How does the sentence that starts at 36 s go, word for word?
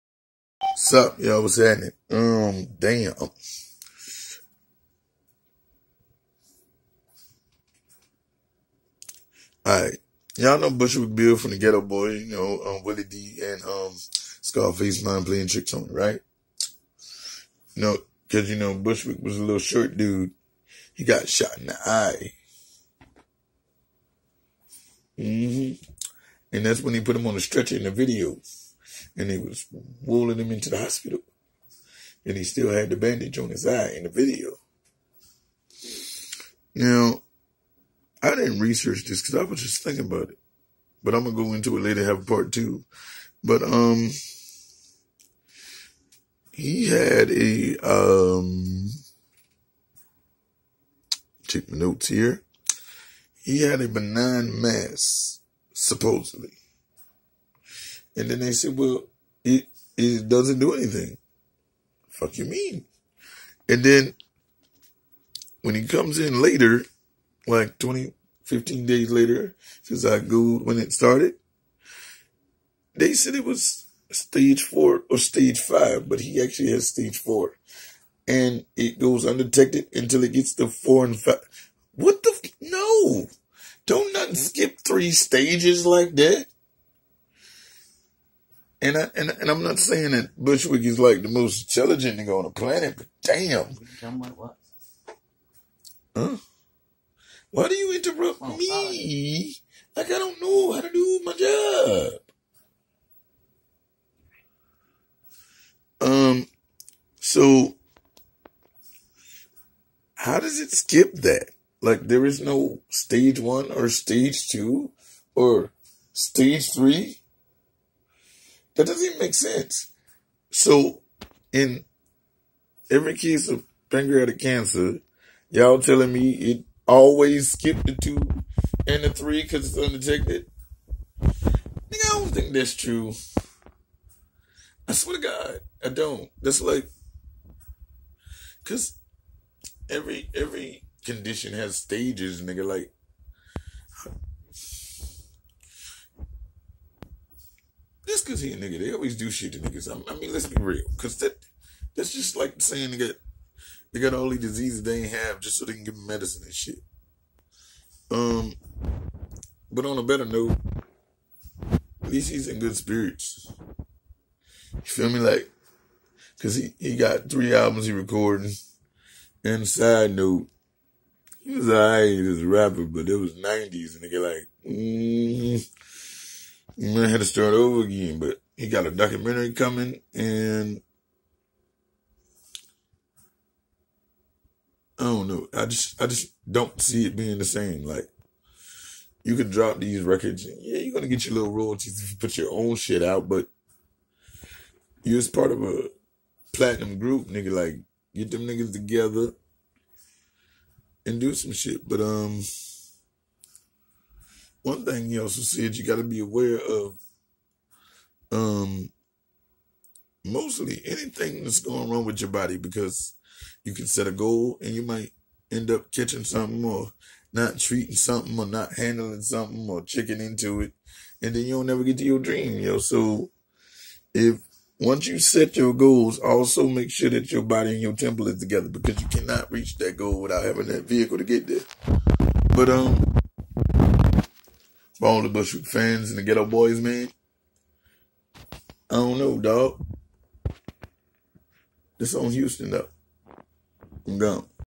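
Now, I didn't research this because I was just thinking about it.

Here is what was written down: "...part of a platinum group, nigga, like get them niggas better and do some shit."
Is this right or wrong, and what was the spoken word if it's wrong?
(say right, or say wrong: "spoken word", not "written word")
wrong: "together", not "better".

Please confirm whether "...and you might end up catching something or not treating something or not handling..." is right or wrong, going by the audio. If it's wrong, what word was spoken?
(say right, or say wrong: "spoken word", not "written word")
right.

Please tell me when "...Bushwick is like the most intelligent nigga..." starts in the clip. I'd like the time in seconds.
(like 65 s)
90 s.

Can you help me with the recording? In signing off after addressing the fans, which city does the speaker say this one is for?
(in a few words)
Houston.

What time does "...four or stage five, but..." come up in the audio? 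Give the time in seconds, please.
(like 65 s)
74 s.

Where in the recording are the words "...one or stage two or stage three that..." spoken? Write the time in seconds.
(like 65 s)
113 s.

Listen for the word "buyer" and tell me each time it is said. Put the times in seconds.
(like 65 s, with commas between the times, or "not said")
not said.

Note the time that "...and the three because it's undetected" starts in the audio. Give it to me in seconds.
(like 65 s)
128 s.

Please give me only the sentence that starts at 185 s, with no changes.
I just I just don't see it being the same.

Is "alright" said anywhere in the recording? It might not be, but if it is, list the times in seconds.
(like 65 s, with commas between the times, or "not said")
9 s, 171 s.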